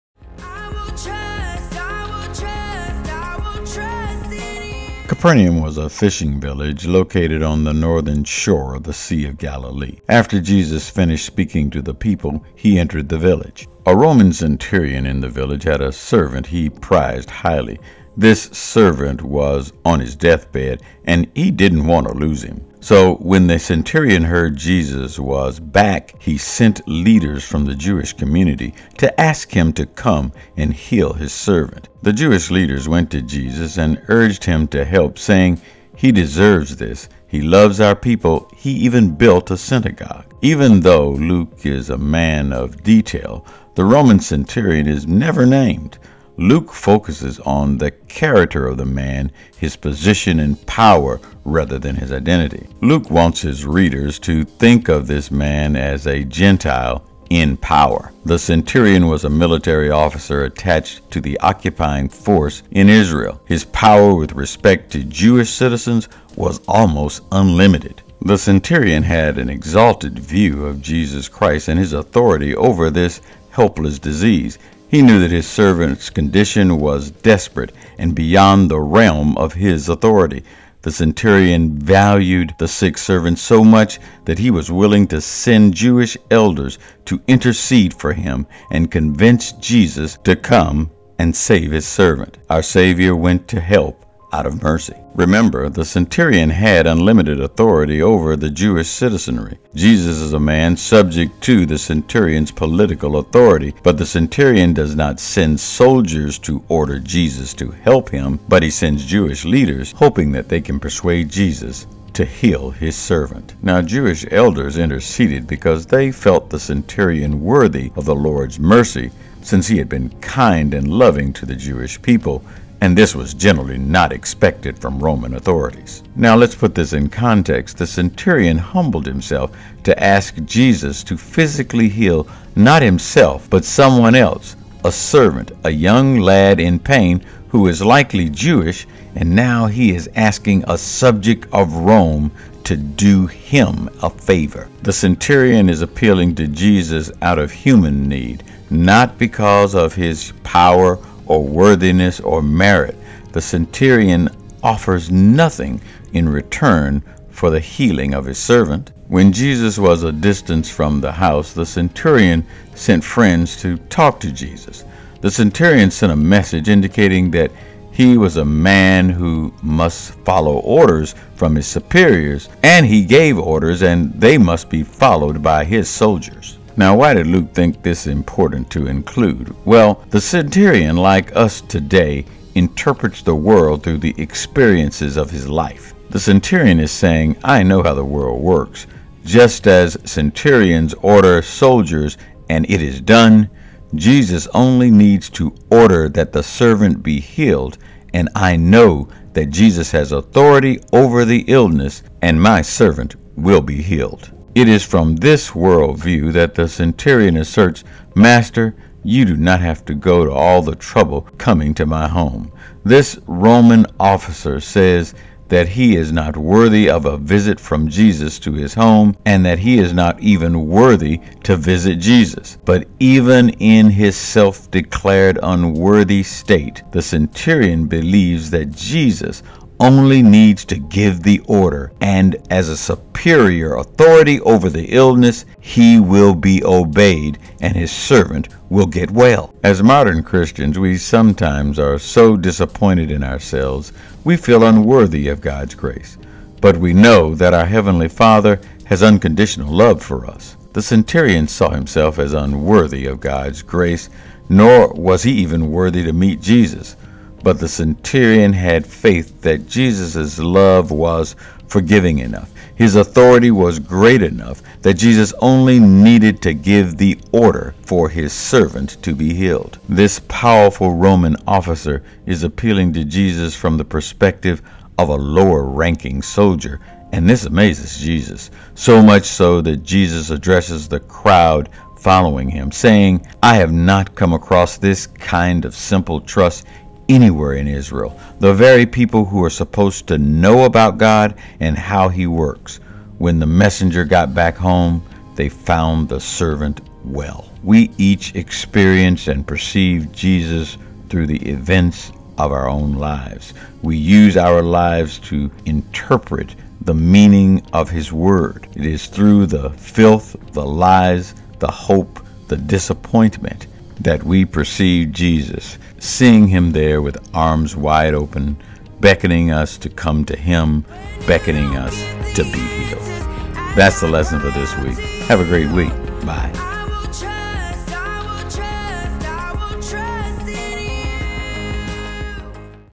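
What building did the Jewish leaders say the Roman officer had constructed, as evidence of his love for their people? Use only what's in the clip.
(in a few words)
A synagogue.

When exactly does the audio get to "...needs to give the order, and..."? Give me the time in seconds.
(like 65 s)
230 s.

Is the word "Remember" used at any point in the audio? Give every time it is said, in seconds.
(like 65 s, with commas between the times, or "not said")
95 s.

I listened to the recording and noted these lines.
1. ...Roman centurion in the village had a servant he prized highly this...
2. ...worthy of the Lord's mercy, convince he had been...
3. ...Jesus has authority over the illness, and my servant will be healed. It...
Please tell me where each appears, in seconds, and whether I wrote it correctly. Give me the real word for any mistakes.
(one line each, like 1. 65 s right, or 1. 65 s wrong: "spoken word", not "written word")
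1. 13 s right
2. 117 s wrong: "since", not "convince"
3. 199 s right.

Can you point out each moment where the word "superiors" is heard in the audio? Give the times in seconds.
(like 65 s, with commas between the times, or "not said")
171 s, 232 s.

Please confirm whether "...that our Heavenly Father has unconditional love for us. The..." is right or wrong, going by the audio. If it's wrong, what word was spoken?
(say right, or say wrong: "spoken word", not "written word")
right.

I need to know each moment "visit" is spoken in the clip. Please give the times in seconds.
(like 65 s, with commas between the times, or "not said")
217 s, 221 s.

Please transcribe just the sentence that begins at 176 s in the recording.
Now, why did Luke think this important to include?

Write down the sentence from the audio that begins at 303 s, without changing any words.
We use our lives to interpret the meaning of His Word.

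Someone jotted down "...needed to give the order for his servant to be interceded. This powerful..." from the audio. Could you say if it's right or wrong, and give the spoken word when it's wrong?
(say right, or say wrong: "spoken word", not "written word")
wrong: "healed", not "interceded".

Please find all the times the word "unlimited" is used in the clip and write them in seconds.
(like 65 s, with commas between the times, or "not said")
67 s, 96 s.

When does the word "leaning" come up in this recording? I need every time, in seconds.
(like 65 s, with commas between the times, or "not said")
not said.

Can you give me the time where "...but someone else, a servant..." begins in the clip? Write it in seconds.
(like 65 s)
133 s.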